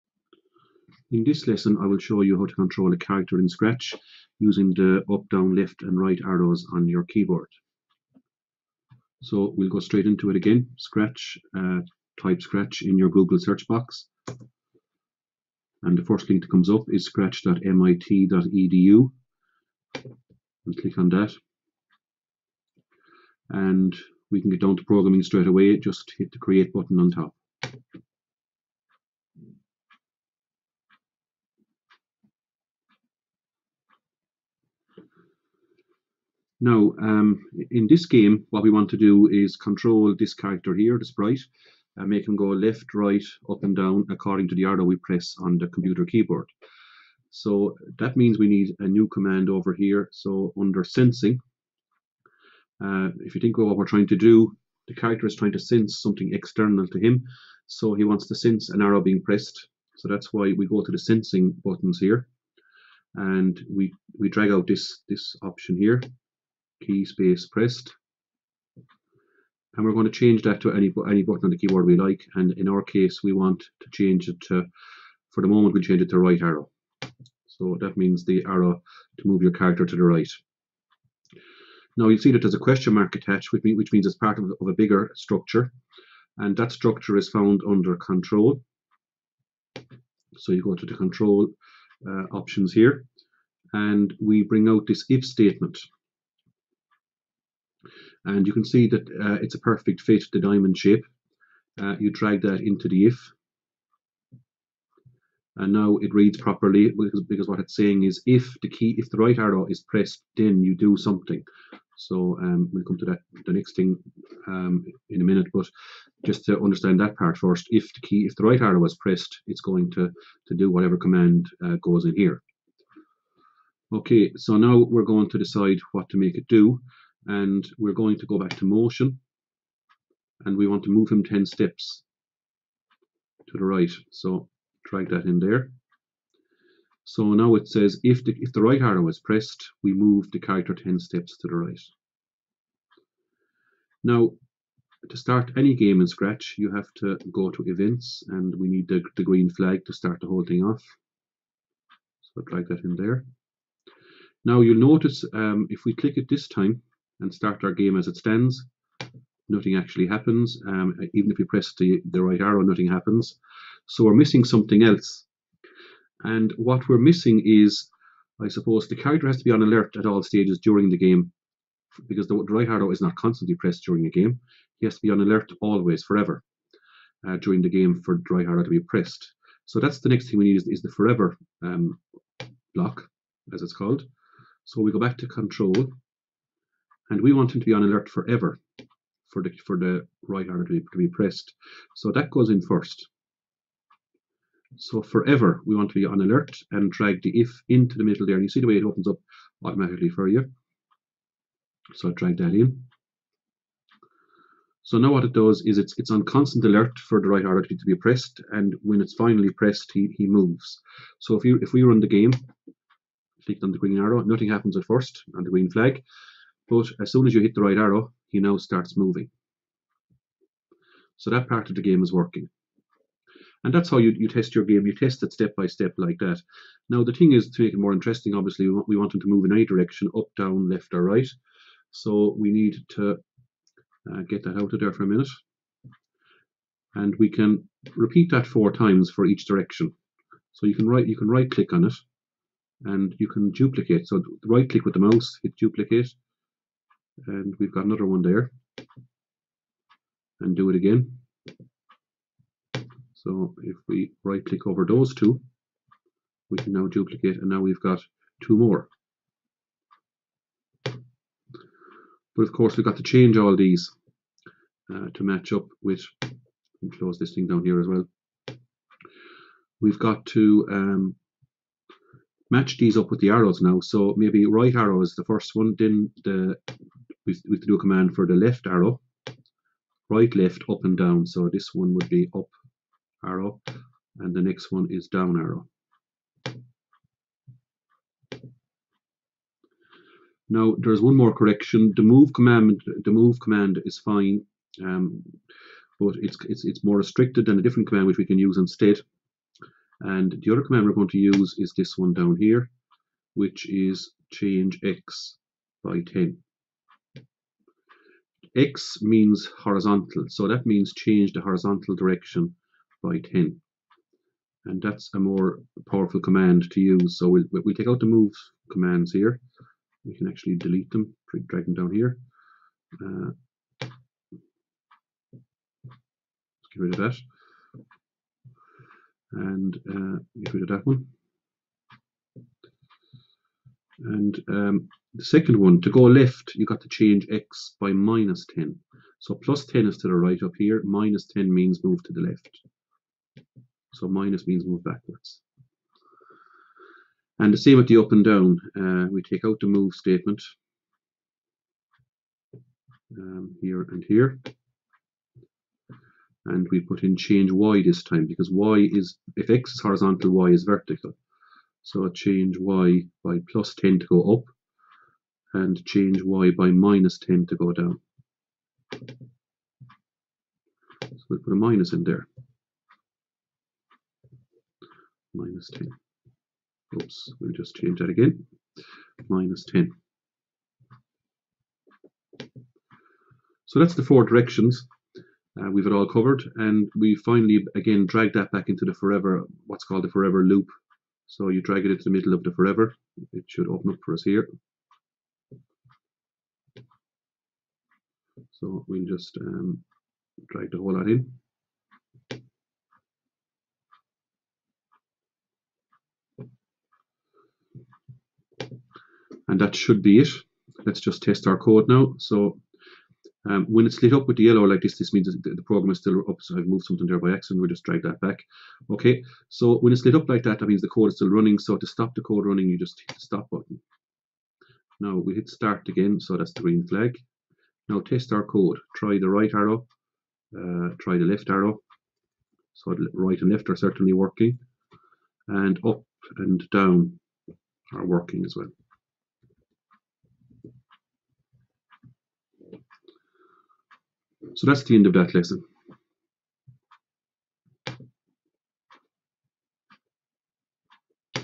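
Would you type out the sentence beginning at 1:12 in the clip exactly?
And in our case, we want to change it to, for the moment, we change it to right arrow.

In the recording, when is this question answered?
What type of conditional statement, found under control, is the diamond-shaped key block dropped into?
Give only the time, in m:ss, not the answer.
1:35.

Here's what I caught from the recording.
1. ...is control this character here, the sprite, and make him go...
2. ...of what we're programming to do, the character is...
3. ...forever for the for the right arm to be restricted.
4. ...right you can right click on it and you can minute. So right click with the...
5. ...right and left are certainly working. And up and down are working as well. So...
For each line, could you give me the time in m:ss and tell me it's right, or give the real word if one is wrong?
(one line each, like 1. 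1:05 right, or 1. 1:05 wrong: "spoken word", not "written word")
1. 0:39 right
2. 0:53 wrong: "trying", not "programming"
3. 3:08 wrong: "pressed", not "restricted"
4. 4:00 wrong: "duplicate", not "minute"
5. 7:13 right.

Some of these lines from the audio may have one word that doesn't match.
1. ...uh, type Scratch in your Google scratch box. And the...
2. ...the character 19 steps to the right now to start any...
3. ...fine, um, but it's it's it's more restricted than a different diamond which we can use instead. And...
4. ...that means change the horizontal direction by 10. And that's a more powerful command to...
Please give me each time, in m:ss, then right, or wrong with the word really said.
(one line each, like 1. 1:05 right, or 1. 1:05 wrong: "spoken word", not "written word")
1. 0:11 wrong: "search", not "scratch"
2. 2:20 wrong: "10", not "19"
3. 4:53 wrong: "command", not "diamond"
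4. 5:10 right.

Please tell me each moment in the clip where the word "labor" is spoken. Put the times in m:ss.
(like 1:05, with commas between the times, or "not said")
not said.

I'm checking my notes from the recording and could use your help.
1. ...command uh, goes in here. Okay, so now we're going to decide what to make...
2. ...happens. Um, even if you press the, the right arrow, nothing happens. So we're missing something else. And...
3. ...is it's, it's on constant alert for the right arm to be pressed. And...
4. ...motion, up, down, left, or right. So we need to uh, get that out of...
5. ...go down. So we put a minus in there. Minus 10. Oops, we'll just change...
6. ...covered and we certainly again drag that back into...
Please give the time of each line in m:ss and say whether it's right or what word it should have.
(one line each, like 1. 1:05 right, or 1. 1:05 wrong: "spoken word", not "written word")
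1. 2:00 right
2. 2:40 right
3. 3:25 right
4. 3:49 wrong: "direction", not "motion"
5. 6:07 right
6. 6:26 wrong: "finally", not "certainly".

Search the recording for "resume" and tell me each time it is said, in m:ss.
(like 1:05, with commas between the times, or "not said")
not said.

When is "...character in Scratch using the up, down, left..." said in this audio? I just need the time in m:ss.
0:02.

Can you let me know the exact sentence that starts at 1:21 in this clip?
Now you'll see that there's a question mark attached, which, which means it's part of, of a bigger structure.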